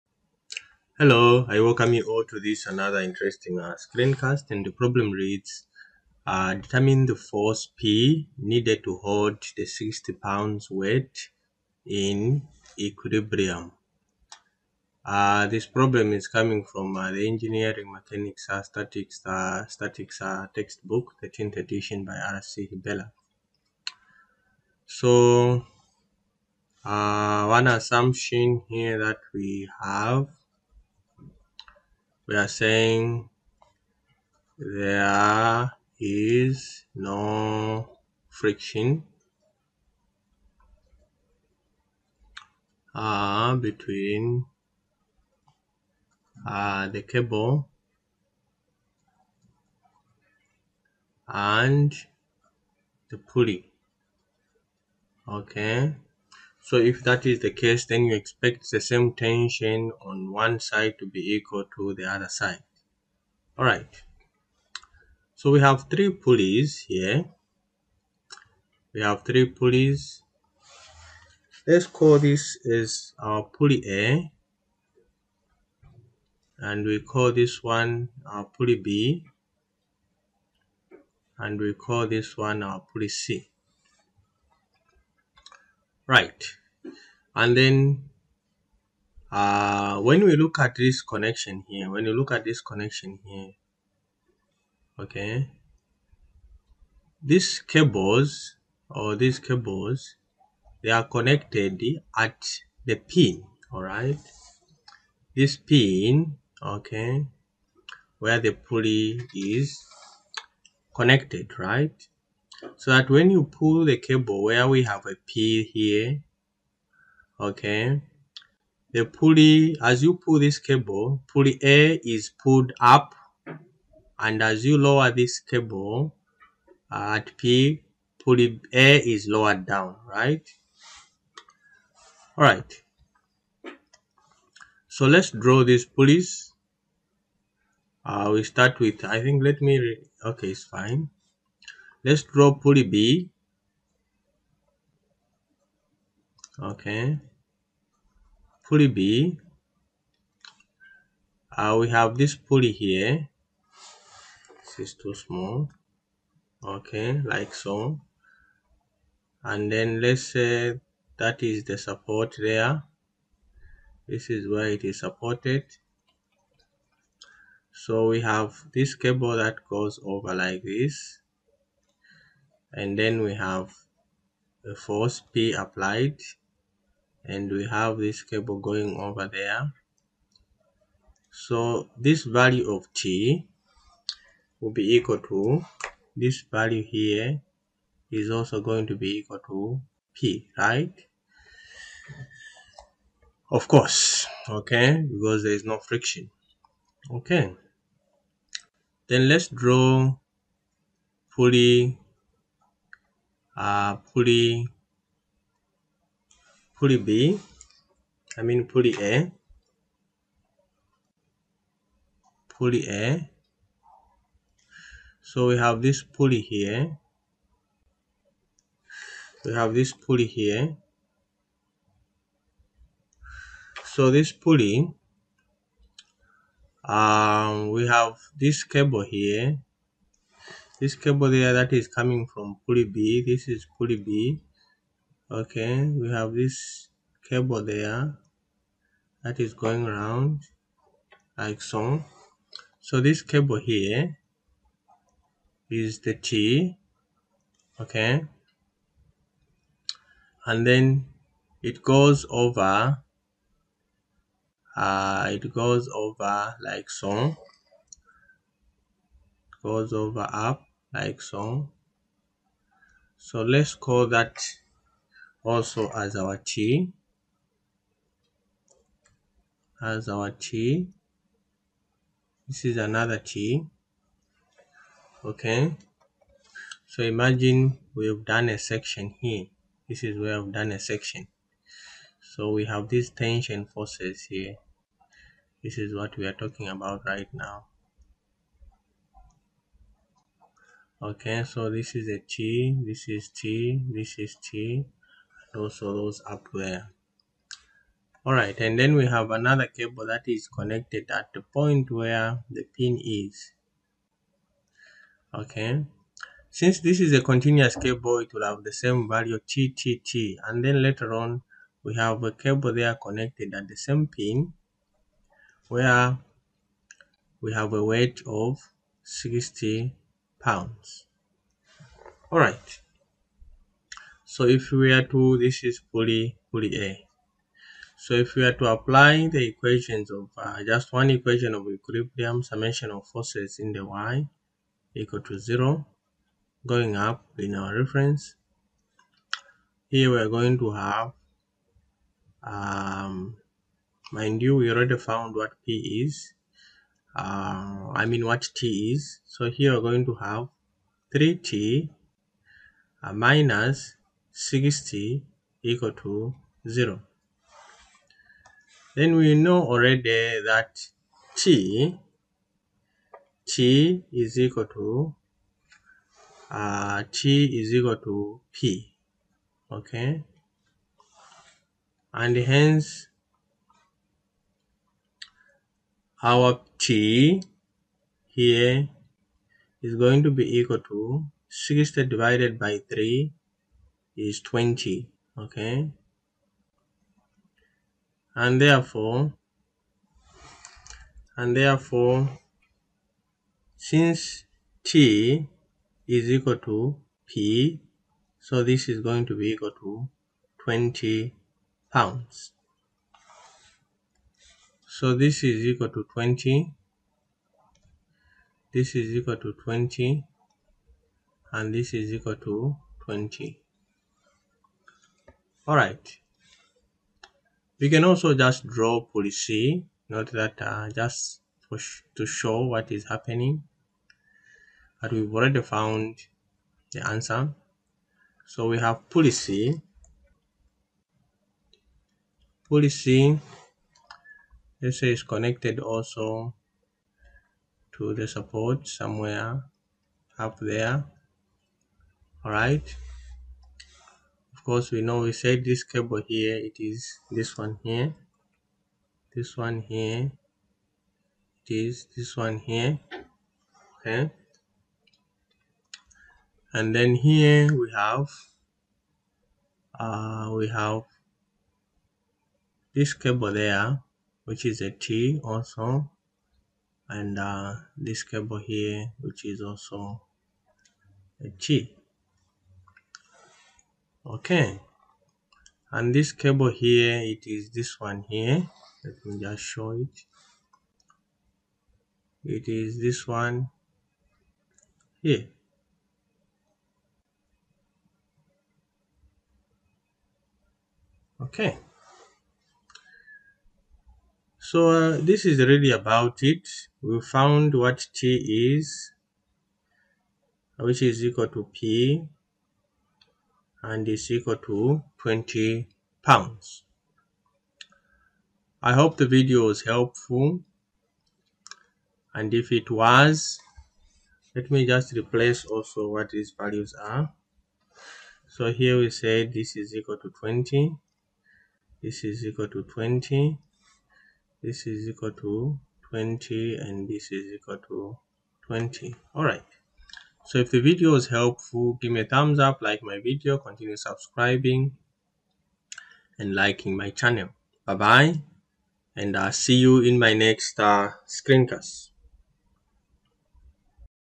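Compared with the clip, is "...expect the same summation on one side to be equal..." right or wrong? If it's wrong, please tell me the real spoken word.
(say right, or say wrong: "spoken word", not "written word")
wrong: "tension", not "summation".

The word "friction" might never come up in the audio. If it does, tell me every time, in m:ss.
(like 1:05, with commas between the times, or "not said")
0:38, 3:15.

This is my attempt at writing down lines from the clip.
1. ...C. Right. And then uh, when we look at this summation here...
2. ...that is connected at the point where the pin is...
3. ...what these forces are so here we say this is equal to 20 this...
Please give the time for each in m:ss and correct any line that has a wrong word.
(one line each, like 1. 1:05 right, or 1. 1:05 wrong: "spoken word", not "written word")
1. 1:23 wrong: "connection", not "summation"
2. 5:00 right
3. 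8:36 wrong: "values", not "forces".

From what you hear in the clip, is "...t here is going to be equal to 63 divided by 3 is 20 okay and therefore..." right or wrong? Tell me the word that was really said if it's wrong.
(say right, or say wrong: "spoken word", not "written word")
wrong: "60", not "63".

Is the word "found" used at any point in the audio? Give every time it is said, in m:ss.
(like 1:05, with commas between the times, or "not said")
5:44, 7:05, 8:17.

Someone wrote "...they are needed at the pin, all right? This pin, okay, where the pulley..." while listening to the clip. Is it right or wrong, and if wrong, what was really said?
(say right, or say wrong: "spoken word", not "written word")
wrong: "connected", not "needed".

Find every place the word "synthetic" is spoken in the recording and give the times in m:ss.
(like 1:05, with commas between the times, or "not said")
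not said.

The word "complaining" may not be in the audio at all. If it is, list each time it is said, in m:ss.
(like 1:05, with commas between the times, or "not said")
not said.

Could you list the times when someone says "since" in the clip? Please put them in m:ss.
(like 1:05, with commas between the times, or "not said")
5:06, 6:33.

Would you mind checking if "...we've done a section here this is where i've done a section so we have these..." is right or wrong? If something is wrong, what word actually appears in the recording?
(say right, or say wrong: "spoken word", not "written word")
right.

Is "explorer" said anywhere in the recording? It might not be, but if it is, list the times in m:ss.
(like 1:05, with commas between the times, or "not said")
not said.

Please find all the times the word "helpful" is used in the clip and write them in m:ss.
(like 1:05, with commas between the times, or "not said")
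8:29, 8:51.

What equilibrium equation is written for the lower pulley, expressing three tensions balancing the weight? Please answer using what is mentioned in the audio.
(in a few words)
3T - 60 = 0.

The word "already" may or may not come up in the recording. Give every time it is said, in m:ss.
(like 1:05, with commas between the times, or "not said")
5:44, 5:59, 7:05.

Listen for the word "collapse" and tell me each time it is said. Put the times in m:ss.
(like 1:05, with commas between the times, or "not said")
not said.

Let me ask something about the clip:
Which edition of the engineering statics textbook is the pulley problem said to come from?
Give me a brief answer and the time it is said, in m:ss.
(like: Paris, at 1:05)
10th edition, at 0:21.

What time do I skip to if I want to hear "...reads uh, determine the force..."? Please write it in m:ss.
0:05.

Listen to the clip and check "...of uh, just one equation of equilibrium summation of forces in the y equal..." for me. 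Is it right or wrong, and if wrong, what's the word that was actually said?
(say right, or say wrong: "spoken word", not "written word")
right.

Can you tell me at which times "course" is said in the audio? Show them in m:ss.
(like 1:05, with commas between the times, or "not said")
3:13, 7:24.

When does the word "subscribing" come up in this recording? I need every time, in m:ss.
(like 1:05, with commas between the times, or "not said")
8:53.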